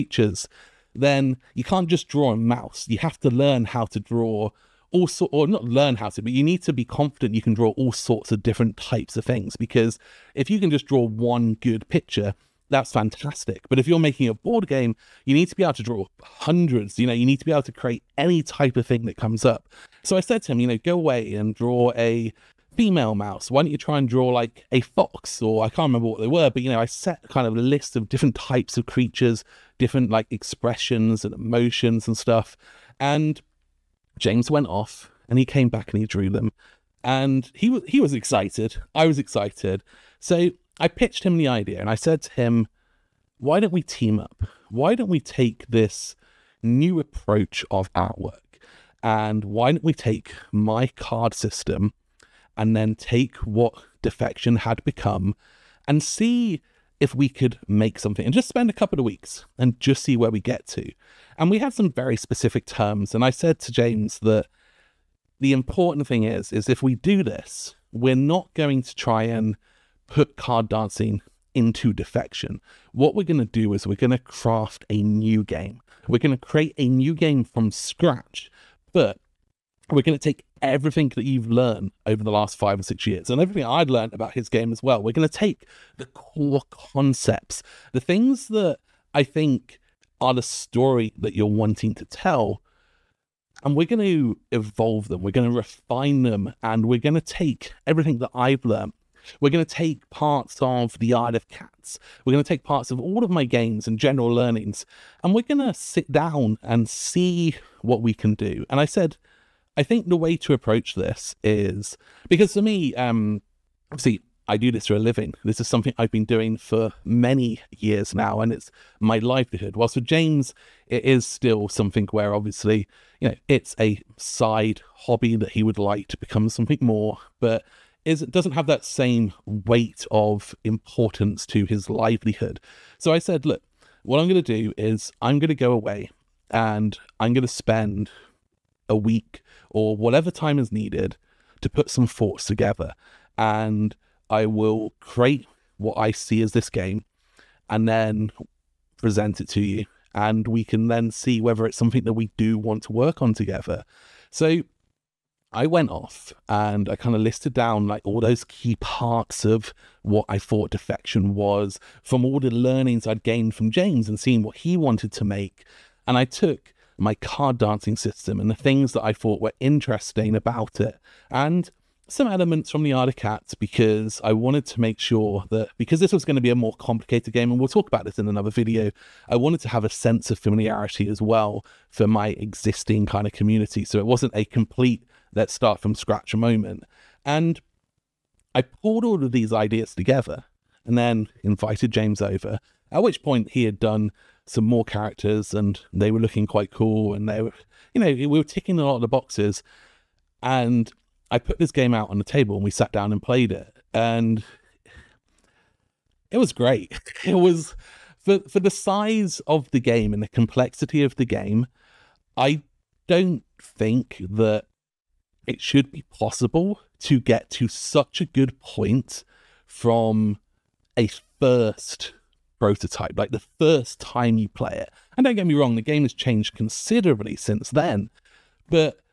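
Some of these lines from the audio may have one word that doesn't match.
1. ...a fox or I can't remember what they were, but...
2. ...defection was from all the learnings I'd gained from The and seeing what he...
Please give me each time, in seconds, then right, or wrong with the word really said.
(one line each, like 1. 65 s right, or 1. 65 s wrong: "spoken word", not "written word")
1. 24 s right
2. 160 s wrong: "James", not "The".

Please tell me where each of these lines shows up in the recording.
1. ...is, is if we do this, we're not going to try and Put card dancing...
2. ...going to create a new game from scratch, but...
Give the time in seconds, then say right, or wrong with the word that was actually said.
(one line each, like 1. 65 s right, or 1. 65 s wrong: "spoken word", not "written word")
1. 66 s right
2. 76 s right.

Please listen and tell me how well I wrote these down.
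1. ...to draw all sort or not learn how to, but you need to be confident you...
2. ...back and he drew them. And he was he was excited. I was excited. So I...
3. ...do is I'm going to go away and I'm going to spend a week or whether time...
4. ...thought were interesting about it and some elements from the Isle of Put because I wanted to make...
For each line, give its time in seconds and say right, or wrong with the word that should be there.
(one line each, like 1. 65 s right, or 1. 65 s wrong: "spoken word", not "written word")
1. 3 s right
2. 35 s right
3. 134 s wrong: "whatever", not "whether"
4. 169 s wrong: "Cats", not "Put".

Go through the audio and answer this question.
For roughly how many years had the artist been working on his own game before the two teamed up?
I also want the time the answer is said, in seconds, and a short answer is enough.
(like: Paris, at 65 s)
5 or 6 years, at 82 s.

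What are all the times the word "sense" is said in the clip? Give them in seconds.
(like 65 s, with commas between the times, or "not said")
179 s.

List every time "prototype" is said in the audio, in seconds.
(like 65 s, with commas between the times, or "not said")
222 s.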